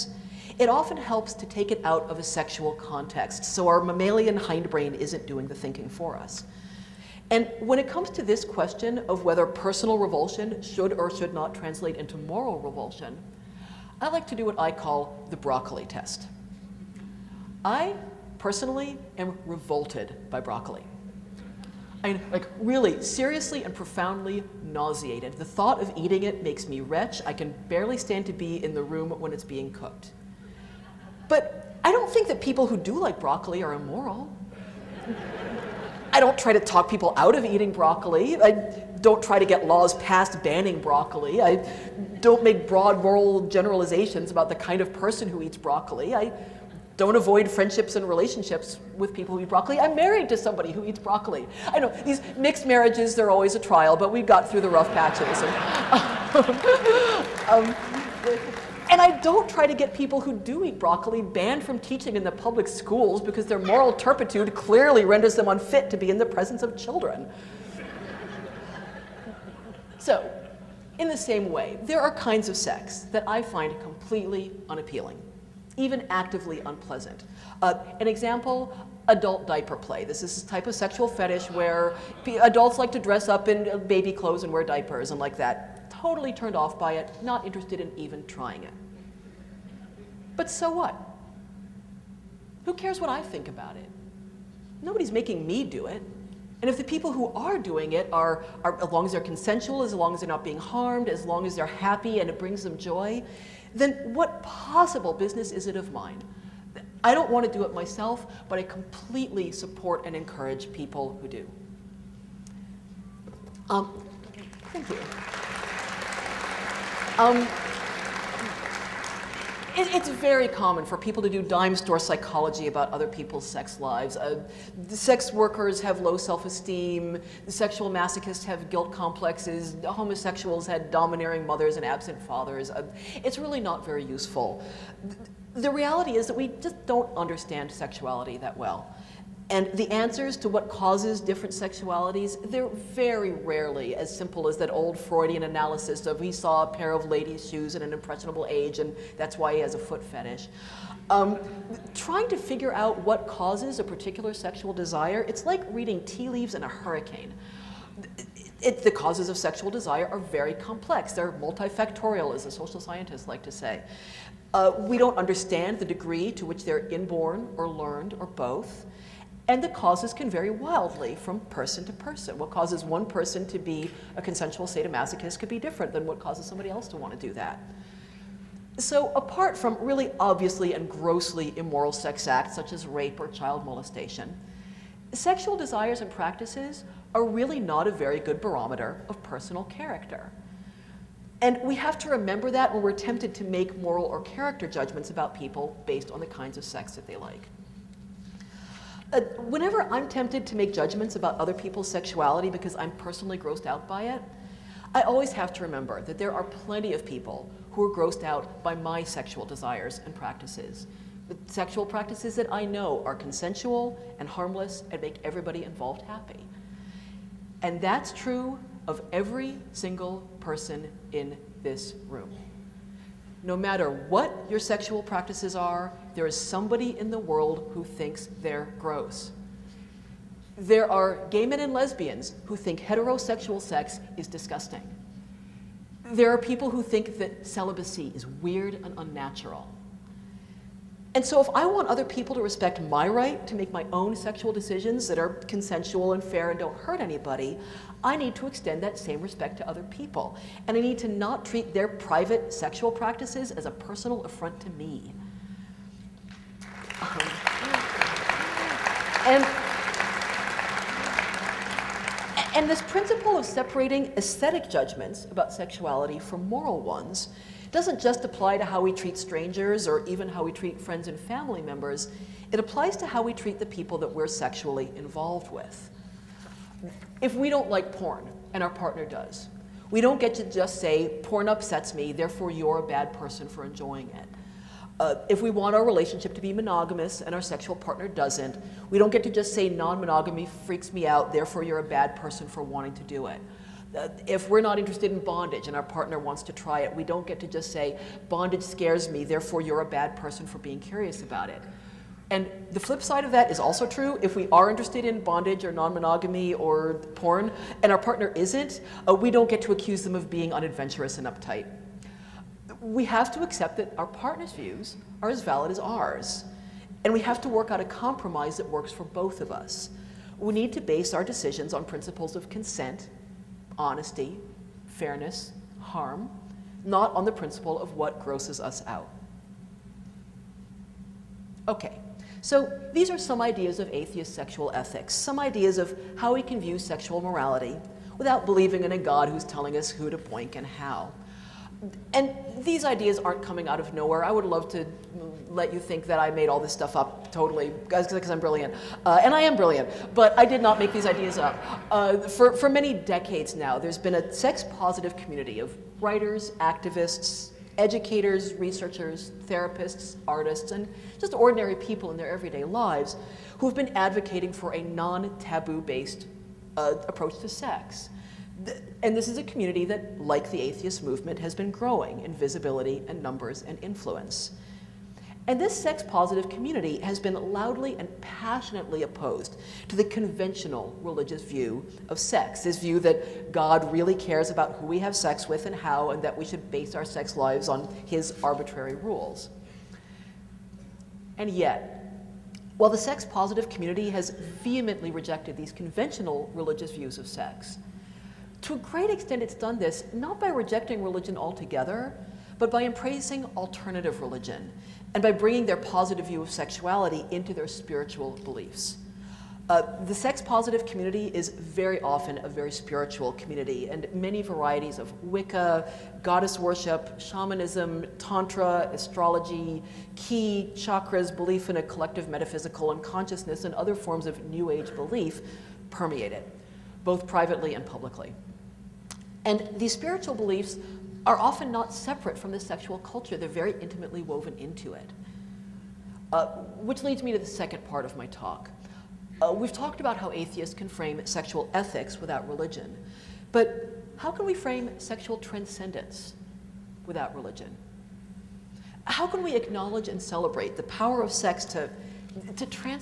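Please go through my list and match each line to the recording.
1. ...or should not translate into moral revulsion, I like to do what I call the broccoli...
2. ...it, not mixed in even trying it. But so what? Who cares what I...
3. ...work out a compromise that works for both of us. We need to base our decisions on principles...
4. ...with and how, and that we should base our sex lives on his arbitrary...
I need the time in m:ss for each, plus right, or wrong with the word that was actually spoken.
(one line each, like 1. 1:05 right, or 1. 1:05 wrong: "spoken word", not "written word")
1. 0:10 right
2. 1:26 wrong: "interested", not "mixed"
3. 5:17 right
4. 6:25 right.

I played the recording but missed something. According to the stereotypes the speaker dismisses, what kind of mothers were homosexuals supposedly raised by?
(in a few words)
Domineering mothers.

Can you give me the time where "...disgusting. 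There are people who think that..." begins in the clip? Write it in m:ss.
3:54.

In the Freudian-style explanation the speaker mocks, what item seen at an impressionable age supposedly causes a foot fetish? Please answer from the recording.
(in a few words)
Ladies' shoes.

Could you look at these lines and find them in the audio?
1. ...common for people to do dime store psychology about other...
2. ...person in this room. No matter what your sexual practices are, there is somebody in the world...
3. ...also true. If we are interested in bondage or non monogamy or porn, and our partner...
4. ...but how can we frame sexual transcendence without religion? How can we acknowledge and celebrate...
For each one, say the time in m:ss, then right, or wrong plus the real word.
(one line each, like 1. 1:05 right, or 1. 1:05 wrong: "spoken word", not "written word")
1. 2:00 right
2. 3:40 right
3. 5:03 right
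4. 7:23 right.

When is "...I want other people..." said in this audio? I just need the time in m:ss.
4:01.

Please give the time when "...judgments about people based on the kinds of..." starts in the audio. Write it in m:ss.
3:14.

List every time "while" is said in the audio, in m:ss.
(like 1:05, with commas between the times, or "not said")
6:32.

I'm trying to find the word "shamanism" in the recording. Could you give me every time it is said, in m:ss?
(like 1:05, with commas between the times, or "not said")
6:57.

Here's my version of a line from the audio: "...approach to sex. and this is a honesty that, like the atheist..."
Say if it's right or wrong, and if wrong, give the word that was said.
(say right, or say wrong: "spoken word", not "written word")
wrong: "community", not "honesty".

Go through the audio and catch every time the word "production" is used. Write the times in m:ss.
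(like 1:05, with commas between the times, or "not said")
not said.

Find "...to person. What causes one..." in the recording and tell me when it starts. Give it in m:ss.
2:51.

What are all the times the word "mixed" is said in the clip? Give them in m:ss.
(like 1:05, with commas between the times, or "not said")
0:52.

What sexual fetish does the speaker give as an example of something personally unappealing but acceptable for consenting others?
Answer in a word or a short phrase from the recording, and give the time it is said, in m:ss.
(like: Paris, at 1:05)
Adult diaper play, at 1:19.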